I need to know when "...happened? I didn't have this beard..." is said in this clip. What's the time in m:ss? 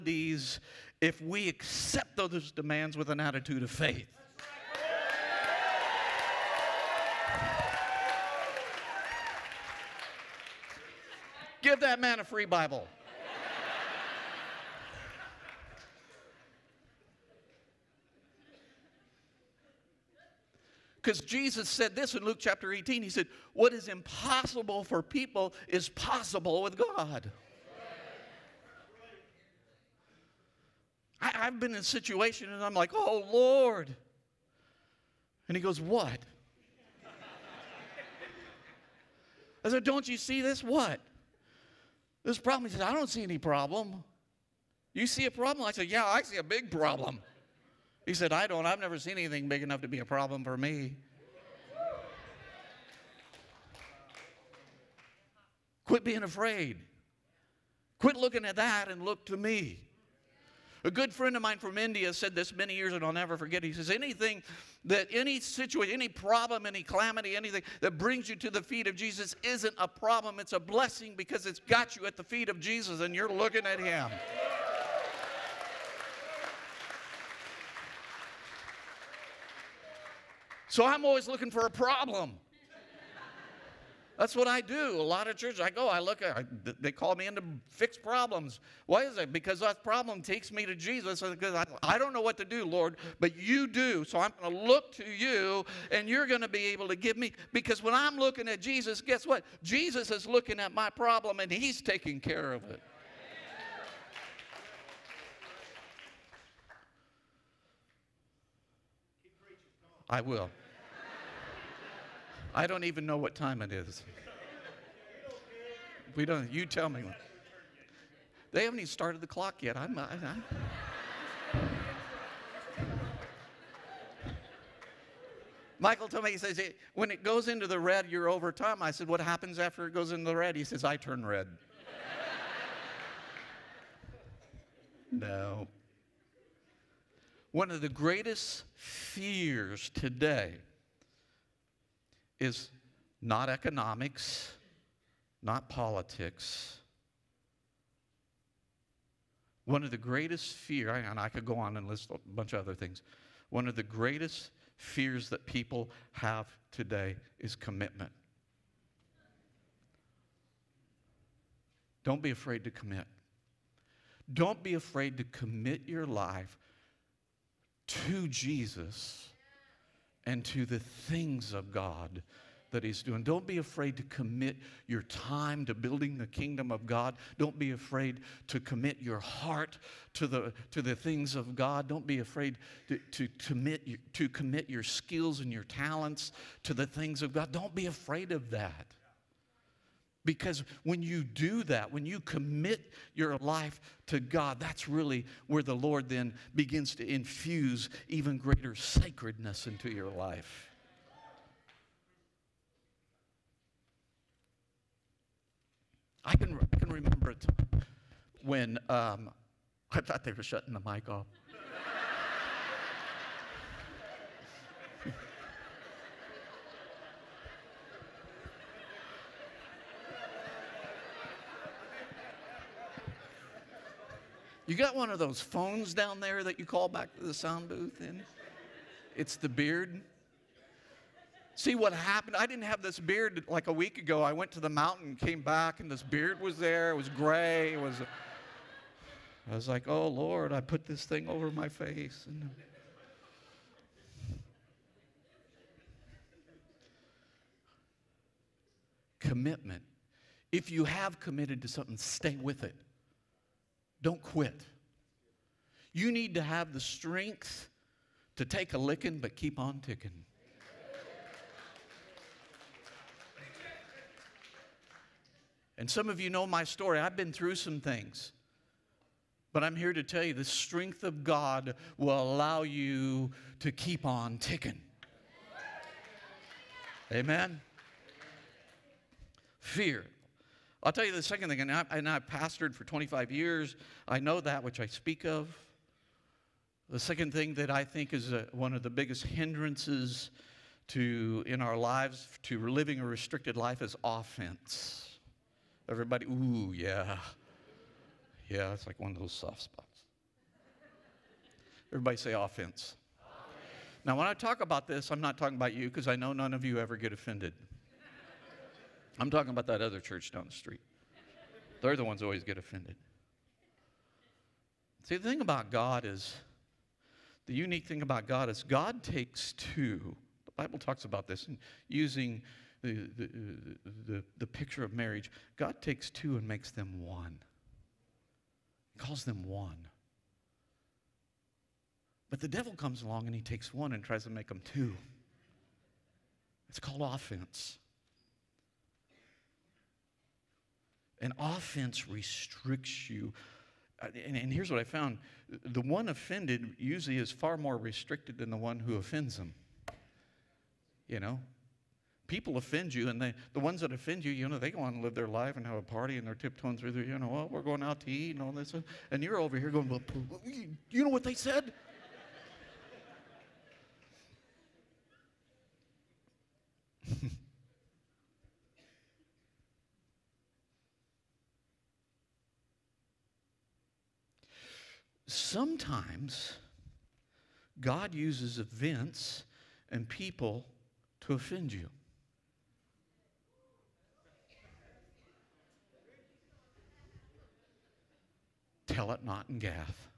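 3:51.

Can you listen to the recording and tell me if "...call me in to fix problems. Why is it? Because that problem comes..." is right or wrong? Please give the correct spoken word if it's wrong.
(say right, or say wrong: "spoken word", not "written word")
wrong: "takes", not "comes".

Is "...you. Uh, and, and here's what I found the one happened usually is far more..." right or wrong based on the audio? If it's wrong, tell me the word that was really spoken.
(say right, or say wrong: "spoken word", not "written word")
wrong: "offended", not "happened".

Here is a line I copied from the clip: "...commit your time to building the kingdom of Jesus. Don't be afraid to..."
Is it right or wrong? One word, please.
wrong.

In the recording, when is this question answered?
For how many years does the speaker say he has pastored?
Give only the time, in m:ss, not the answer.
4:42.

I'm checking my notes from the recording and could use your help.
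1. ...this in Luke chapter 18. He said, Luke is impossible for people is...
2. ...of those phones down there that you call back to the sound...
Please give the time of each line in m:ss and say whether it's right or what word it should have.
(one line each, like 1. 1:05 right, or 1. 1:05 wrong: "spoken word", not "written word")
1. 0:21 wrong: "What", not "Luke"
2. 3:45 right.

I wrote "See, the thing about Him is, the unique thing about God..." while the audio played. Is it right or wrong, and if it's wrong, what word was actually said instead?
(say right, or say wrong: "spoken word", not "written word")
wrong: "God", not "Him".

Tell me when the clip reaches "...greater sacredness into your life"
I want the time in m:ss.
3:18.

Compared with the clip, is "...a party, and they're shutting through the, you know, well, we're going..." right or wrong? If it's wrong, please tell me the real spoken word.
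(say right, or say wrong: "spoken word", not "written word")
wrong: "tiptoeing", not "shutting".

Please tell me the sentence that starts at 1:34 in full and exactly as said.
So I'm going to look to you, and you're going to be able to give me.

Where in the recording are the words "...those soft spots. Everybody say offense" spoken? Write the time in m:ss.
4:59.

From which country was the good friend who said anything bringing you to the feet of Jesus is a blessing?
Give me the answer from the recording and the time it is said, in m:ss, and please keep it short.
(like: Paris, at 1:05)
India, at 1:01.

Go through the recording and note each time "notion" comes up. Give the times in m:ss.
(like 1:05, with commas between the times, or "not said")
not said.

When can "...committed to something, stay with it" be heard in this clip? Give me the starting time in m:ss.
4:11.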